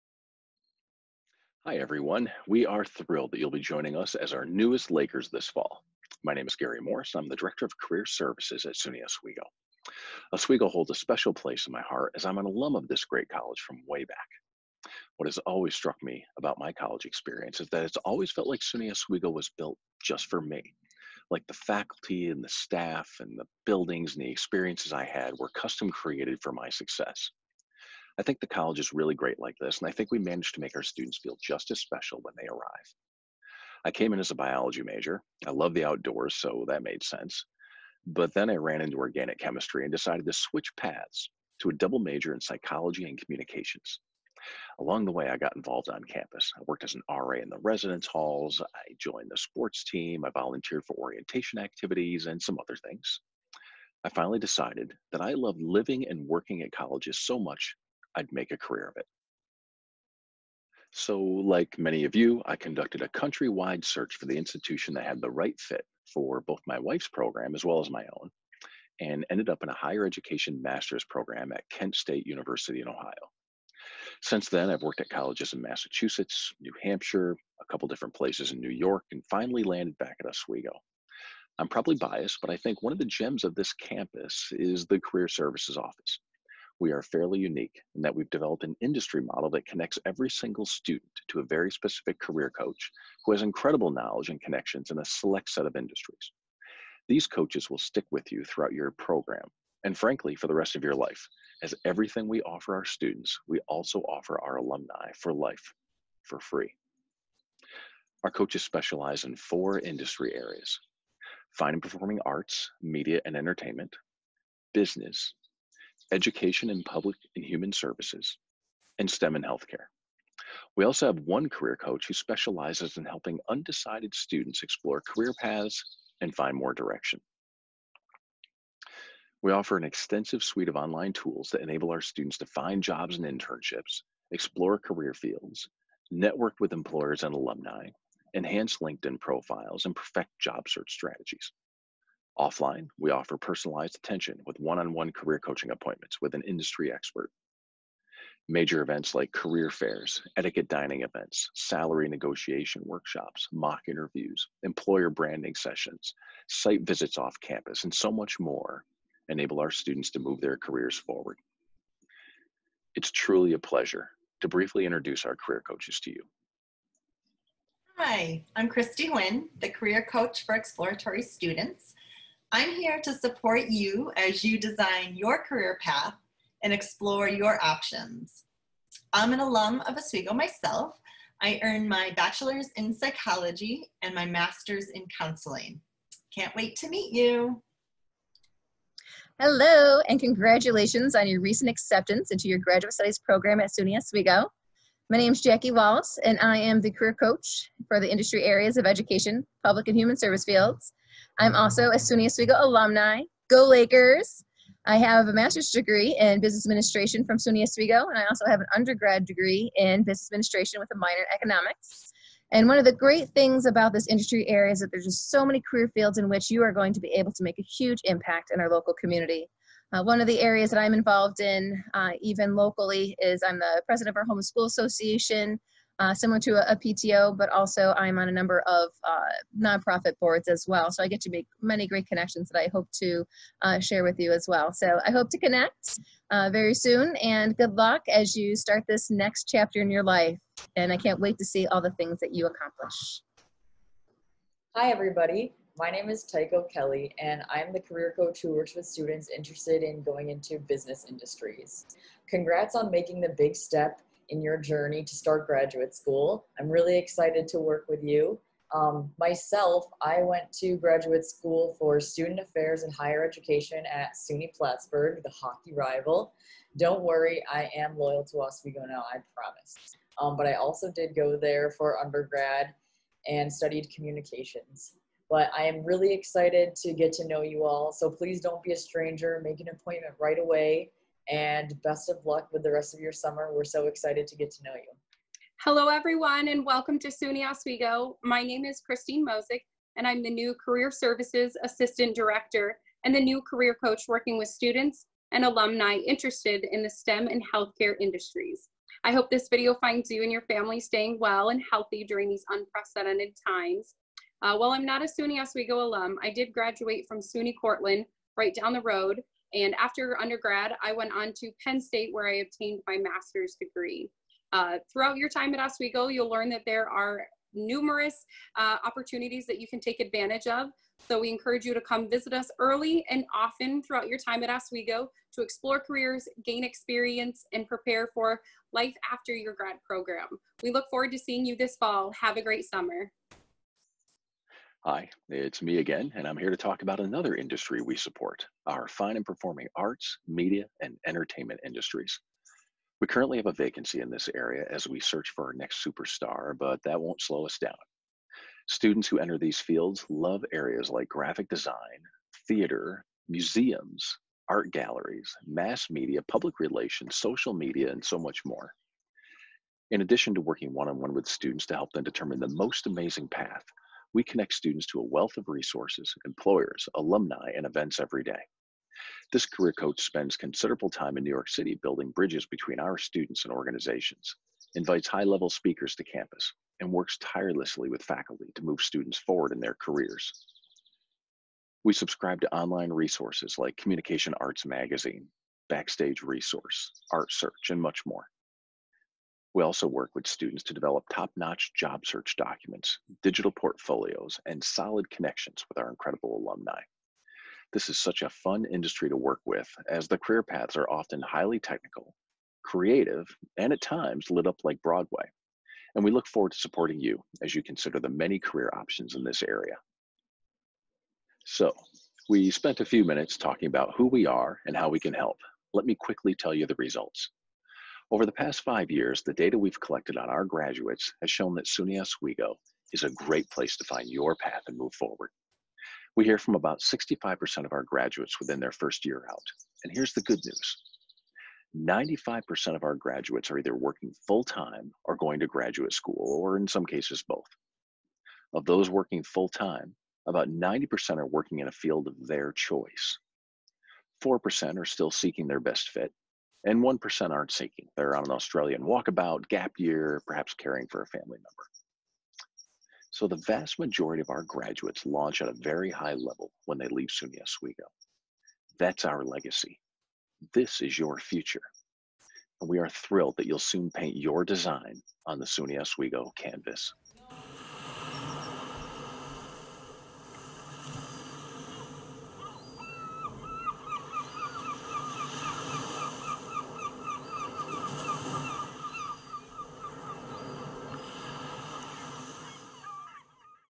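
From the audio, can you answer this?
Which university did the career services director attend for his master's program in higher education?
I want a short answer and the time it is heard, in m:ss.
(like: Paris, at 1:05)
Kent State University, at 1:11.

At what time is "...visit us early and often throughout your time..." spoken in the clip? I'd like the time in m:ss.
5:22.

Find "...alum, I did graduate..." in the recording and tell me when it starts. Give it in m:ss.
5:05.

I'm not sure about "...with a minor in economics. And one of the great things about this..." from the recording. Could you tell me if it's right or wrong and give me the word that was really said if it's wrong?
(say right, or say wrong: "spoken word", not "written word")
right.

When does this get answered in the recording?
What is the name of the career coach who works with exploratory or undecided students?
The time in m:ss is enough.
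2:48.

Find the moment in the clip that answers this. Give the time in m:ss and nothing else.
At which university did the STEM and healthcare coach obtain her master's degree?
5:11.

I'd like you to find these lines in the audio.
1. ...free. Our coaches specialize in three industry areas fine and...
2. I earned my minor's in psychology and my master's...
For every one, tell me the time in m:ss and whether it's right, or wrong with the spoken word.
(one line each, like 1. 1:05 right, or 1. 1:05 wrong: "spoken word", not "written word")
1. 1:46 wrong: "four", not "three"
2. 3:01 wrong: "bachelor", not "minor".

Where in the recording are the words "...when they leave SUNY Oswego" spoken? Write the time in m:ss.
7:36.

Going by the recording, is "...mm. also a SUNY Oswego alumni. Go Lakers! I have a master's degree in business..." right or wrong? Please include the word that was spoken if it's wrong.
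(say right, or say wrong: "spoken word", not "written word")
right.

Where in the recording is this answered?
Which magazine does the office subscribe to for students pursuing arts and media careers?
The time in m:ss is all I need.
6:23.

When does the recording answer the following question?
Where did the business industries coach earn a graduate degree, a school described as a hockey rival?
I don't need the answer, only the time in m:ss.
4:24.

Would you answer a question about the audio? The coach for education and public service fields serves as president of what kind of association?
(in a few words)
homeschool association.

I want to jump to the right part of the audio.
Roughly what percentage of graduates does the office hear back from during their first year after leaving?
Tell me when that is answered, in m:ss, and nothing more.
7:06.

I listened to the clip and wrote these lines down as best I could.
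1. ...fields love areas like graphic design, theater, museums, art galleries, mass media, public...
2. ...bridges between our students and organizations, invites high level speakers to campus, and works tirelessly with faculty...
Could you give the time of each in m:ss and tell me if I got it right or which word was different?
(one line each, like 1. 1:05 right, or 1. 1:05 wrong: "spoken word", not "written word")
1. 5:49 right
2. 6:12 right.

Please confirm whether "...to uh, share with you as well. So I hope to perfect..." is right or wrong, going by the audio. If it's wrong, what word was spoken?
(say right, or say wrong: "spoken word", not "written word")
wrong: "connect", not "perfect".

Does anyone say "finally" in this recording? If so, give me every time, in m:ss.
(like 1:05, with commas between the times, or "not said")
0:54, 1:19.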